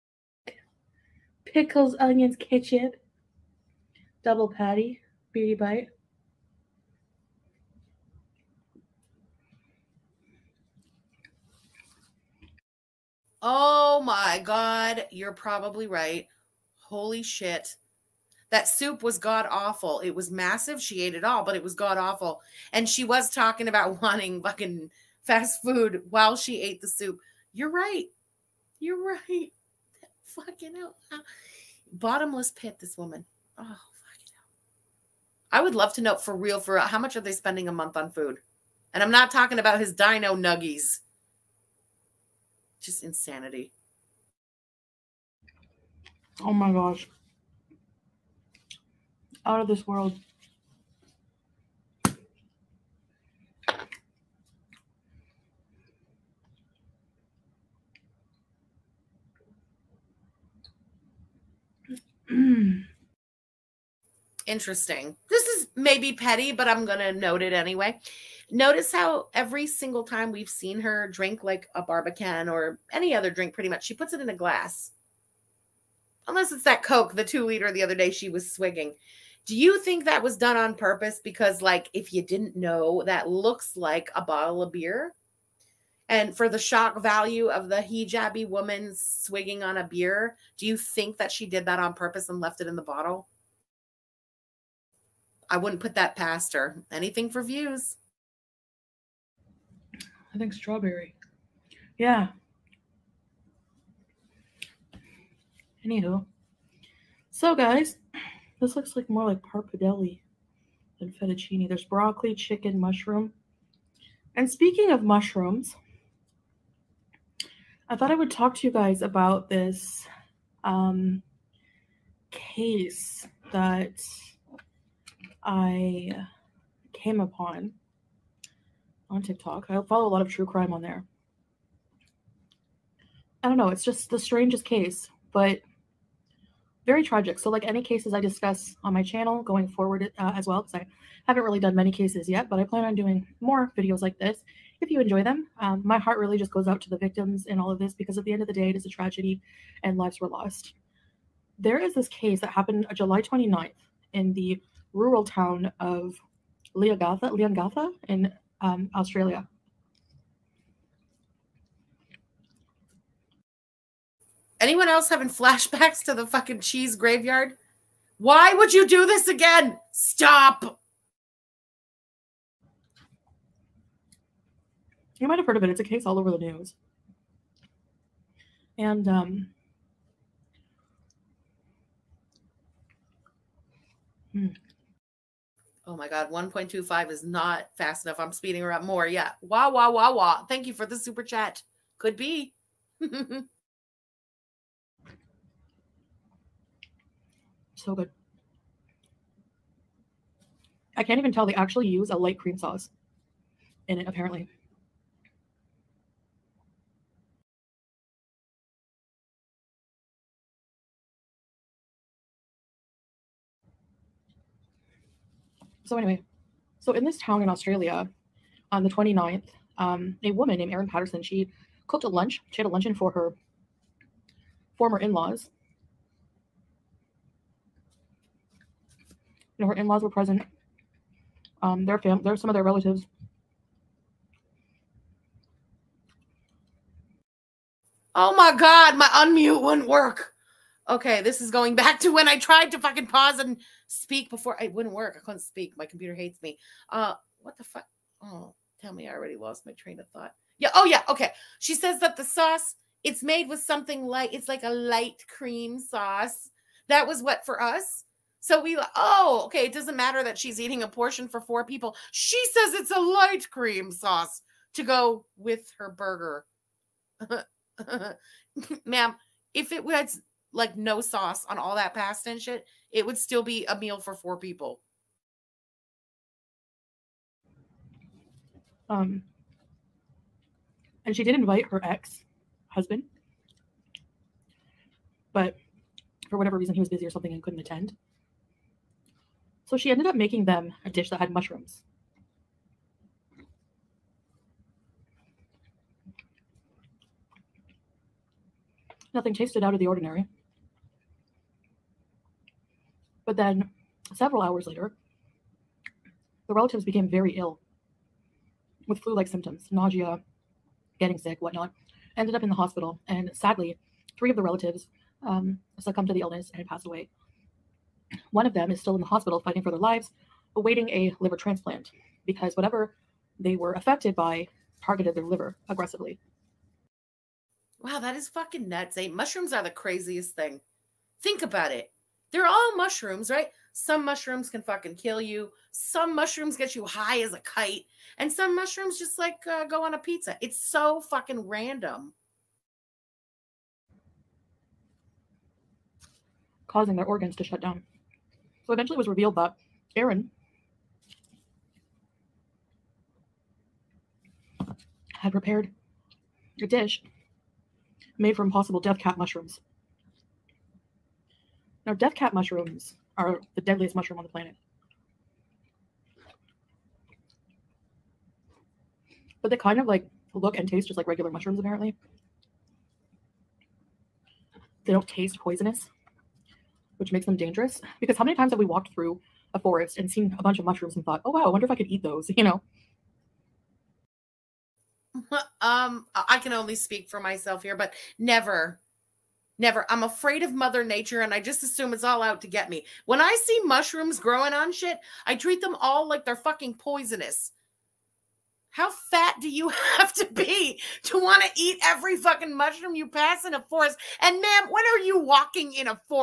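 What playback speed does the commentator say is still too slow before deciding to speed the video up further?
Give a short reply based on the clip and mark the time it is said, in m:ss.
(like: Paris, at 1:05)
1.25, at 3:06.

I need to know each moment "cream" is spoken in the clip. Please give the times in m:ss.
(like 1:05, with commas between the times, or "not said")
3:22, 4:15, 4:23.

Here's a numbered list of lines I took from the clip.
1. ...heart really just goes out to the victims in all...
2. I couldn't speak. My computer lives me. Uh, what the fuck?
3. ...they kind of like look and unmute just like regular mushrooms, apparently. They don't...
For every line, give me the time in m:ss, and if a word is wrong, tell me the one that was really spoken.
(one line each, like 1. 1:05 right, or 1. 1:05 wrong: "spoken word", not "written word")
1. 2:25 right
2. 4:05 wrong: "hates", not "lives"
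3. 6:09 wrong: "taste", not "unmute".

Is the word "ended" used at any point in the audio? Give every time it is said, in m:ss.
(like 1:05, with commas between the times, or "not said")
4:49, 5:12.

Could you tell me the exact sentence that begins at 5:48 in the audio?
So eventually it was revealed that Erin had prepared a dish made from possible death cap mushrooms.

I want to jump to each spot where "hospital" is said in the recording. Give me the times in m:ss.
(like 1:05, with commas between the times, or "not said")
5:12, 5:19.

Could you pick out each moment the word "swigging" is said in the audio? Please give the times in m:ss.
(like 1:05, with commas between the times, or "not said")
1:18, 1:28.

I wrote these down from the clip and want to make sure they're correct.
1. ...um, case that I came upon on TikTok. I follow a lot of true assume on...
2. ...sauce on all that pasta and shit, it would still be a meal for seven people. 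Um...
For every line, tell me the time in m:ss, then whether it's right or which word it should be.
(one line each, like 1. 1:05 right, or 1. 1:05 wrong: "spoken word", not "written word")
1. 2:00 wrong: "crime", not "assume"
2. 4:30 wrong: "four", not "seven".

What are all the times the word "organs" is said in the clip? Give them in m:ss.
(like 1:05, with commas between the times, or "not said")
5:47.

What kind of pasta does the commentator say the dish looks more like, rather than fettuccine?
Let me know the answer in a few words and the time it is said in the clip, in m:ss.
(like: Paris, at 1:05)
pappardelle, at 1:49.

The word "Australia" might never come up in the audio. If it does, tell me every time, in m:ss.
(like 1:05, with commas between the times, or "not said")
2:38, 3:37.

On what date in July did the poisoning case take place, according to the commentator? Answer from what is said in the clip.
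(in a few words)
July 29th.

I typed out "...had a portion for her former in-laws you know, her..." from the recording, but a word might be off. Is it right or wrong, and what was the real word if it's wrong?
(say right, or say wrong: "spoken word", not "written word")
wrong: "luncheon", not "portion".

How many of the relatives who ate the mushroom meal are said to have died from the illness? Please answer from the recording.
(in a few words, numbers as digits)
3.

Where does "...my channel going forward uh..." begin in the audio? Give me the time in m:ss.
2:18.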